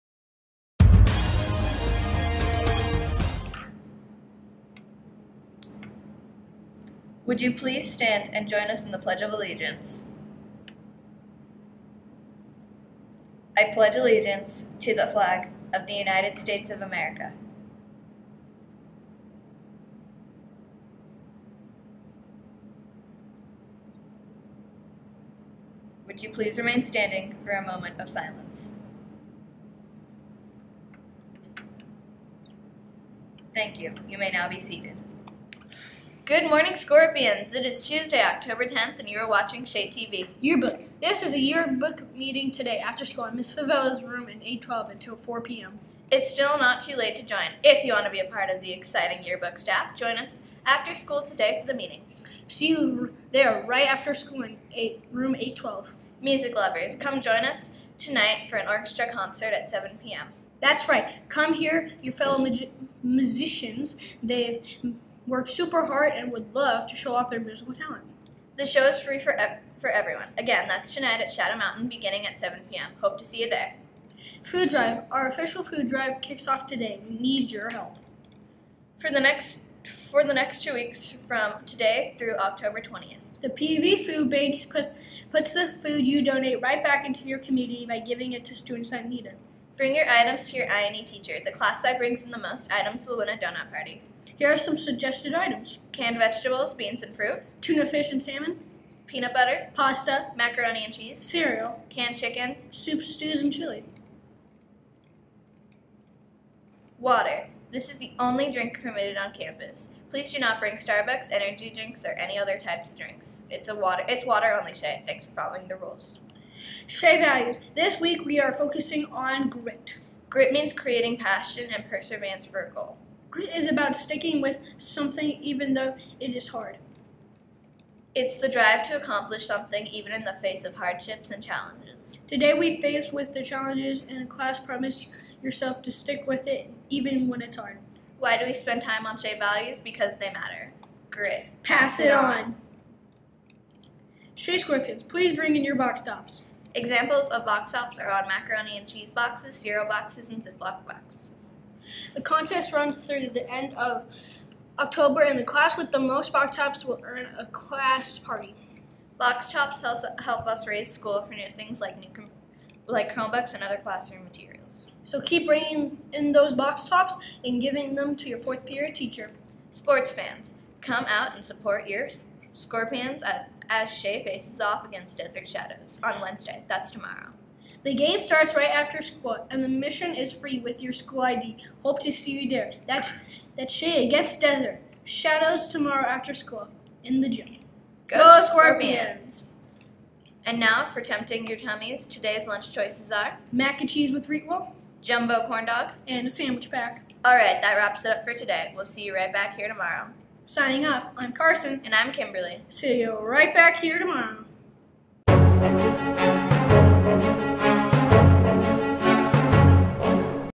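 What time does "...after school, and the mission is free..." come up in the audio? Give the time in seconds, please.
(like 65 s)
178 s.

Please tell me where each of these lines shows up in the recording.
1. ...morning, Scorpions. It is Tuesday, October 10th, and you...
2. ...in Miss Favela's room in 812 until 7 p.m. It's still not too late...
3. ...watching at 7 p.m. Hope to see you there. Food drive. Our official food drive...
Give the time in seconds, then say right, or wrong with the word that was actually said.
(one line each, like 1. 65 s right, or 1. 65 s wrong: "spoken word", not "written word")
1. 36 s right
2. 43 s wrong: "4", not "7"
3. 71 s wrong: "beginning", not "watching".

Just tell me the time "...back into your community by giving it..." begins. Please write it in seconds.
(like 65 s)
86 s.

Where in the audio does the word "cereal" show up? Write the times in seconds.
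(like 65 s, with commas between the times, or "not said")
101 s, 149 s.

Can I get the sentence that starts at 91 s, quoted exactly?
The class that brings in the most items will win a donut party.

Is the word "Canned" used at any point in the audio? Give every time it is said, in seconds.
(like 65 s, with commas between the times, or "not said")
95 s, 101 s.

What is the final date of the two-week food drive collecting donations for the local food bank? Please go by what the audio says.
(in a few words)
October 20th.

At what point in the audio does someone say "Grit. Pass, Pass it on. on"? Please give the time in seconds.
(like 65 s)
141 s.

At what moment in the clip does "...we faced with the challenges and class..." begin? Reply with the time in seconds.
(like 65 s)
132 s.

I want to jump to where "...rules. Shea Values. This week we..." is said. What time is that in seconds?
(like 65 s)
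115 s.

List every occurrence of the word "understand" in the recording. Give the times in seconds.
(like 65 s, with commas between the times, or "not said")
not said.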